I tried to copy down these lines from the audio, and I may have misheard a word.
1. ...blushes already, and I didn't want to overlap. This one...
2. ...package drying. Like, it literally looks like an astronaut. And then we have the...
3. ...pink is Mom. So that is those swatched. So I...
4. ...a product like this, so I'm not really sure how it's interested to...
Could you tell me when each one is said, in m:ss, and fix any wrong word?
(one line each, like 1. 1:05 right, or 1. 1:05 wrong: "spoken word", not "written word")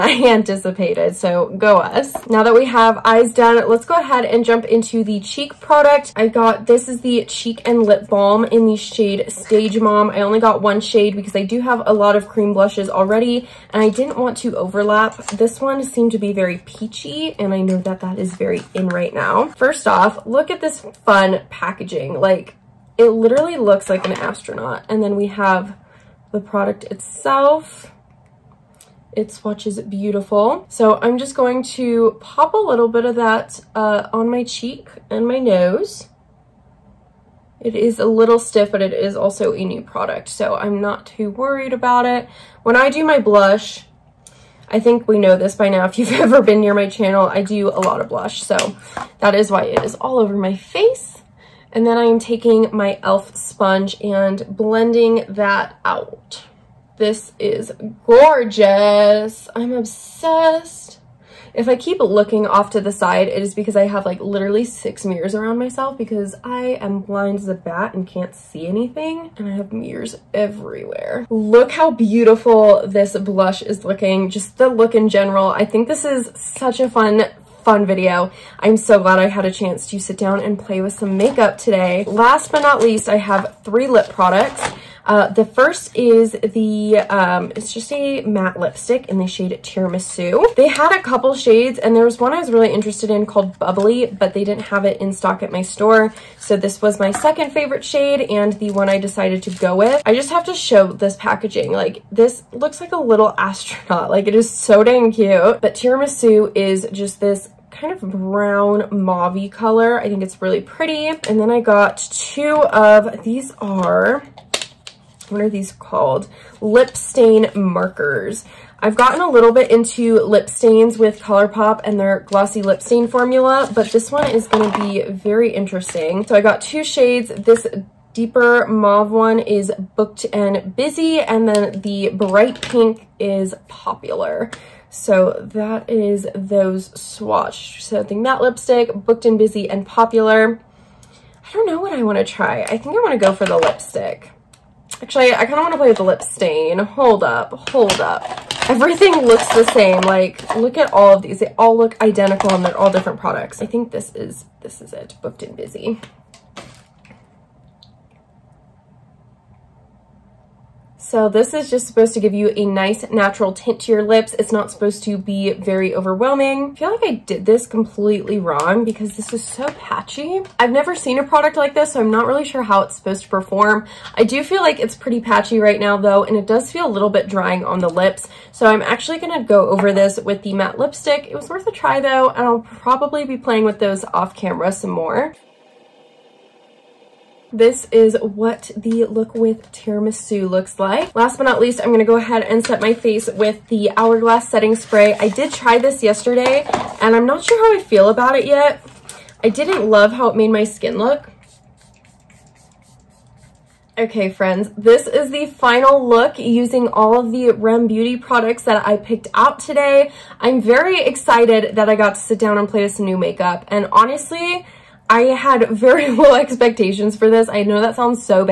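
1. 0:12 right
2. 0:21 wrong: "packaging", not "drying"
3. 2:12 wrong: "Popular", not "Mom"
4. 2:51 wrong: "supposed", not "interested".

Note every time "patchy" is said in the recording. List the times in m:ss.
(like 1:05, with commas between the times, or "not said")
2:49, 2:55.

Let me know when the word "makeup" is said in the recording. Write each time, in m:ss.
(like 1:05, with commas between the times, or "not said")
1:21, 3:33.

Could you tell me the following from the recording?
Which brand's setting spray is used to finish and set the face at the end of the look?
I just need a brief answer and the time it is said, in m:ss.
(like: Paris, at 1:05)
Hourglass, at 3:13.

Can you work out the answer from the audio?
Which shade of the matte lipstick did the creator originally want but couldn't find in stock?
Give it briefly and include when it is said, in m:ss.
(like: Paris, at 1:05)
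Bubbly, at 1:33.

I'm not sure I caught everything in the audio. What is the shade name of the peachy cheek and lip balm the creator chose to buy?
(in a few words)
Stage Mom.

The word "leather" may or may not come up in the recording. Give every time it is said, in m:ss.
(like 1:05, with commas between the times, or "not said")
not said.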